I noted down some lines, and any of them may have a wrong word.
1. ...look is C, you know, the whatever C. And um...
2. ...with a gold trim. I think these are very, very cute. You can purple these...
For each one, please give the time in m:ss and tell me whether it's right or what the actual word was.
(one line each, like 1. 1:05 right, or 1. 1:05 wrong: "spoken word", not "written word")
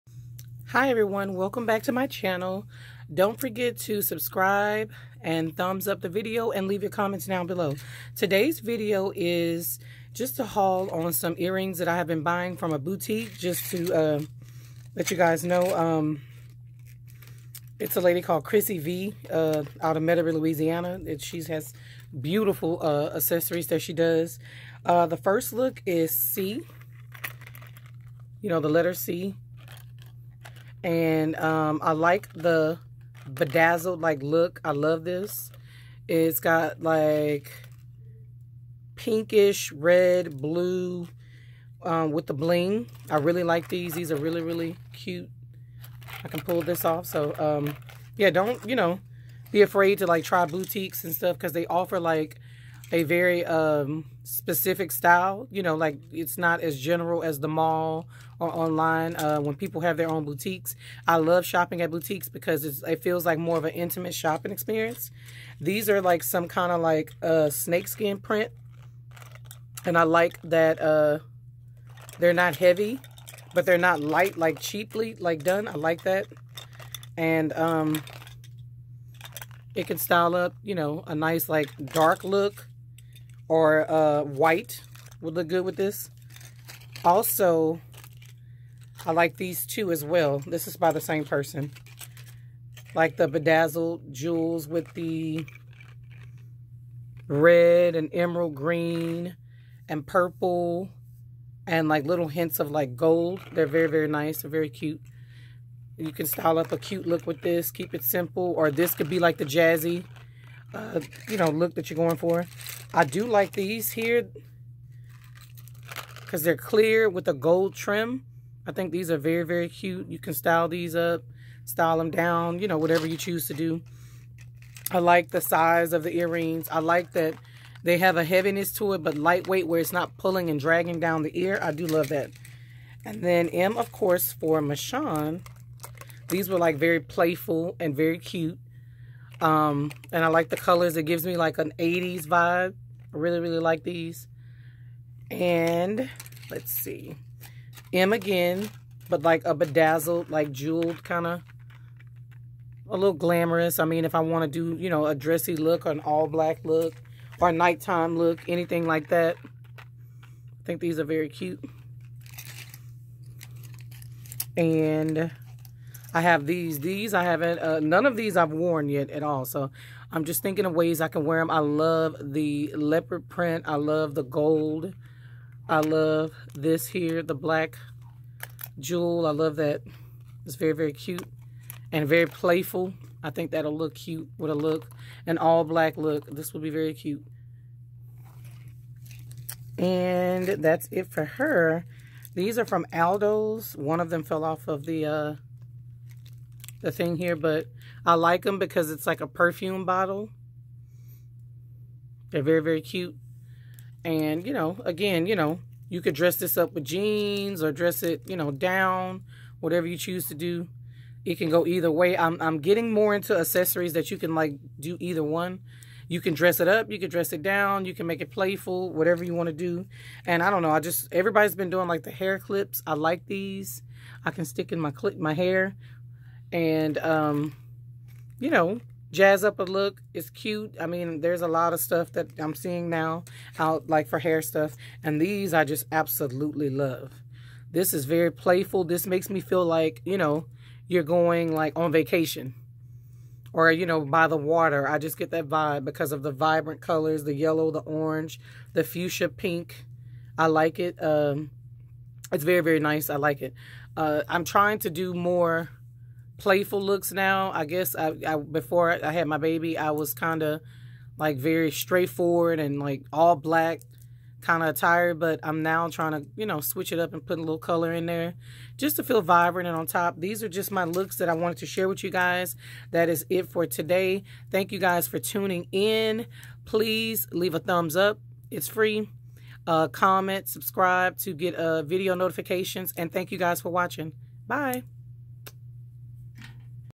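1. 0:25 wrong: "letter", not "whatever"
2. 1:57 wrong: "style", not "purple".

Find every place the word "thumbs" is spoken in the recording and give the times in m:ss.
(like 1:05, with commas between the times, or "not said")
0:05, 4:37.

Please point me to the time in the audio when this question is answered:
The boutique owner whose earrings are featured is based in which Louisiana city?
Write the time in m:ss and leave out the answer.
0:20.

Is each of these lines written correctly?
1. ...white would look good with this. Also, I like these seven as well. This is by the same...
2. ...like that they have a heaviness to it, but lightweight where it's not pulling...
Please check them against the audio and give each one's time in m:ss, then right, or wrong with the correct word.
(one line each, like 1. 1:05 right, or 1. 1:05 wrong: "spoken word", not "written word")
1. 1:24 wrong: "two", not "seven"
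2. 2:06 right.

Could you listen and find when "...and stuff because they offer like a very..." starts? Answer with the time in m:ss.
0:51.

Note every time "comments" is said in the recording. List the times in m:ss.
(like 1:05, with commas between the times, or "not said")
0:06, 4:39.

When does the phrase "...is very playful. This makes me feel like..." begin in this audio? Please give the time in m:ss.
3:57.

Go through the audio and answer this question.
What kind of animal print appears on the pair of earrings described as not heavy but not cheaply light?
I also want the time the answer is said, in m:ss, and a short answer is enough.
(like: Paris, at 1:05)
Snakeskin, at 1:07.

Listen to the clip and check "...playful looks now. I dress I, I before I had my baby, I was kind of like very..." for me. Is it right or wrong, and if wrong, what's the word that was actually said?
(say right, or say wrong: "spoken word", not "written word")
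wrong: "guess", not "dress".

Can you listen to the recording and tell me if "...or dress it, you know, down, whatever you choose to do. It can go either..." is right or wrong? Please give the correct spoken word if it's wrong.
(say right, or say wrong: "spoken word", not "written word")
right.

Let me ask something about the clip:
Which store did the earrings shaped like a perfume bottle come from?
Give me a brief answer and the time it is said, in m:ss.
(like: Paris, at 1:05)
Aldo, at 3:12.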